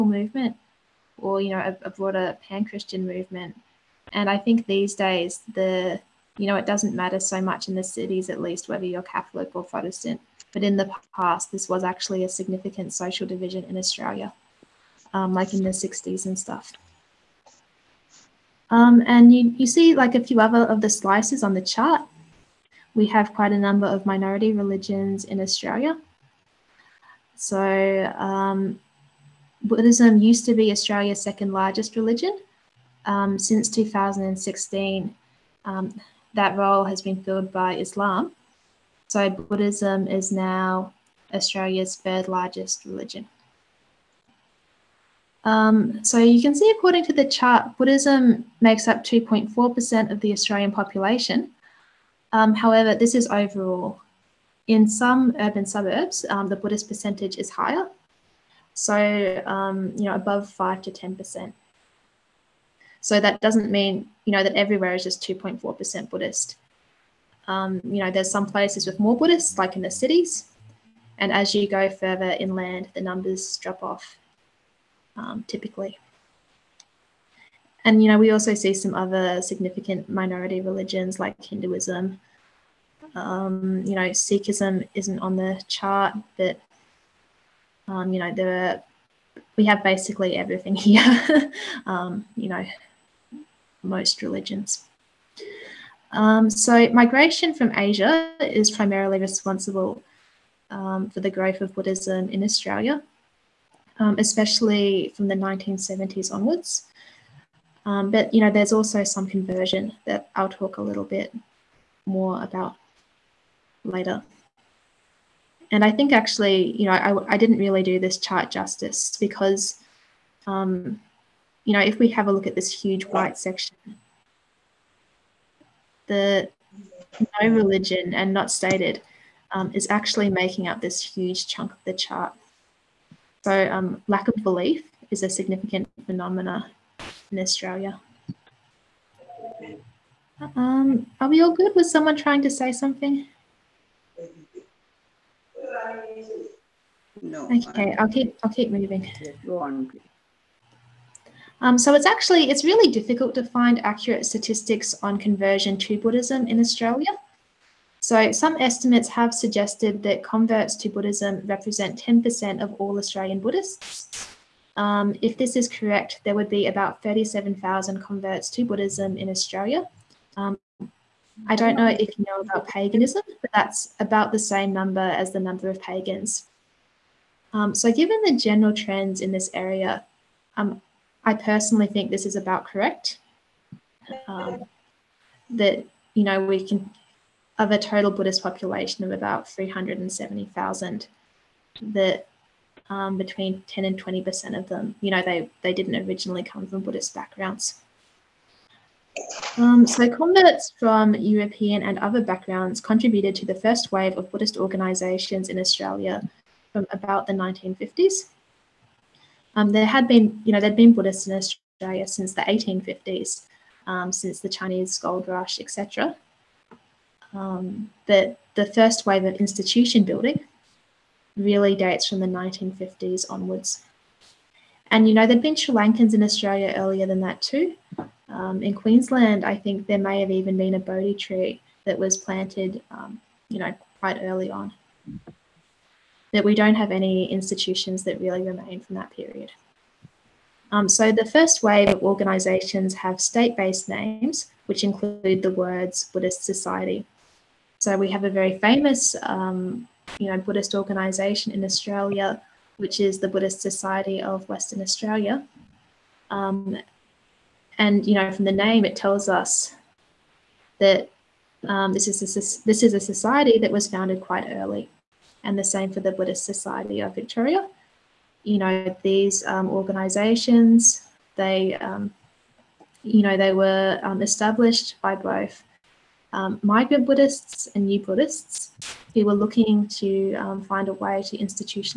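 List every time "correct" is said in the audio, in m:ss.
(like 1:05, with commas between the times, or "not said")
2:45, 3:02.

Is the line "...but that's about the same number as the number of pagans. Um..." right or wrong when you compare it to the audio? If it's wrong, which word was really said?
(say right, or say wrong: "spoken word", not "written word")
right.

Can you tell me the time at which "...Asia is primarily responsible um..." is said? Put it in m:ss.
1:37.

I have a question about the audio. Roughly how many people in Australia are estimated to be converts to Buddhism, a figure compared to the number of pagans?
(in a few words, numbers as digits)
37,000.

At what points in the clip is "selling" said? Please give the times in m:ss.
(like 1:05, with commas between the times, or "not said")
not said.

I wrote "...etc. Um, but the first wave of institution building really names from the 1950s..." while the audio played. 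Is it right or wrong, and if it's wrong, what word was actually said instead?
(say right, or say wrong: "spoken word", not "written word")
wrong: "dates", not "names".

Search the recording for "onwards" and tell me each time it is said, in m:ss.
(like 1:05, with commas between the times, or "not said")
1:46, 3:43.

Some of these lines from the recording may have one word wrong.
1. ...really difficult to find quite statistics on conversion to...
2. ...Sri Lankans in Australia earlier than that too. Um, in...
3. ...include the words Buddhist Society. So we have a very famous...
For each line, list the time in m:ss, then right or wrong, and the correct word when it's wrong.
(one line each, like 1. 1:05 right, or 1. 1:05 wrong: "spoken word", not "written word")
1. 2:32 wrong: "accurate", not "quite"
2. 3:45 right
3. 4:04 right.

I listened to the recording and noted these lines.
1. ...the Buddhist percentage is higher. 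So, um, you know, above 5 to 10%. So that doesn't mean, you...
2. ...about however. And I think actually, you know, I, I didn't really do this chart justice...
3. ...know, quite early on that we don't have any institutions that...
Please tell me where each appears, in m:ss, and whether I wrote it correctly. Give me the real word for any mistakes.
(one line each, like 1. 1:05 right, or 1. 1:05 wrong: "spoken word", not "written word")
1. 0:56 right
2. 1:52 wrong: "later", not "however"
3. 3:53 right.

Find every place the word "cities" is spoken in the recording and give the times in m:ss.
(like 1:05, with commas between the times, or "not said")
0:07, 1:09.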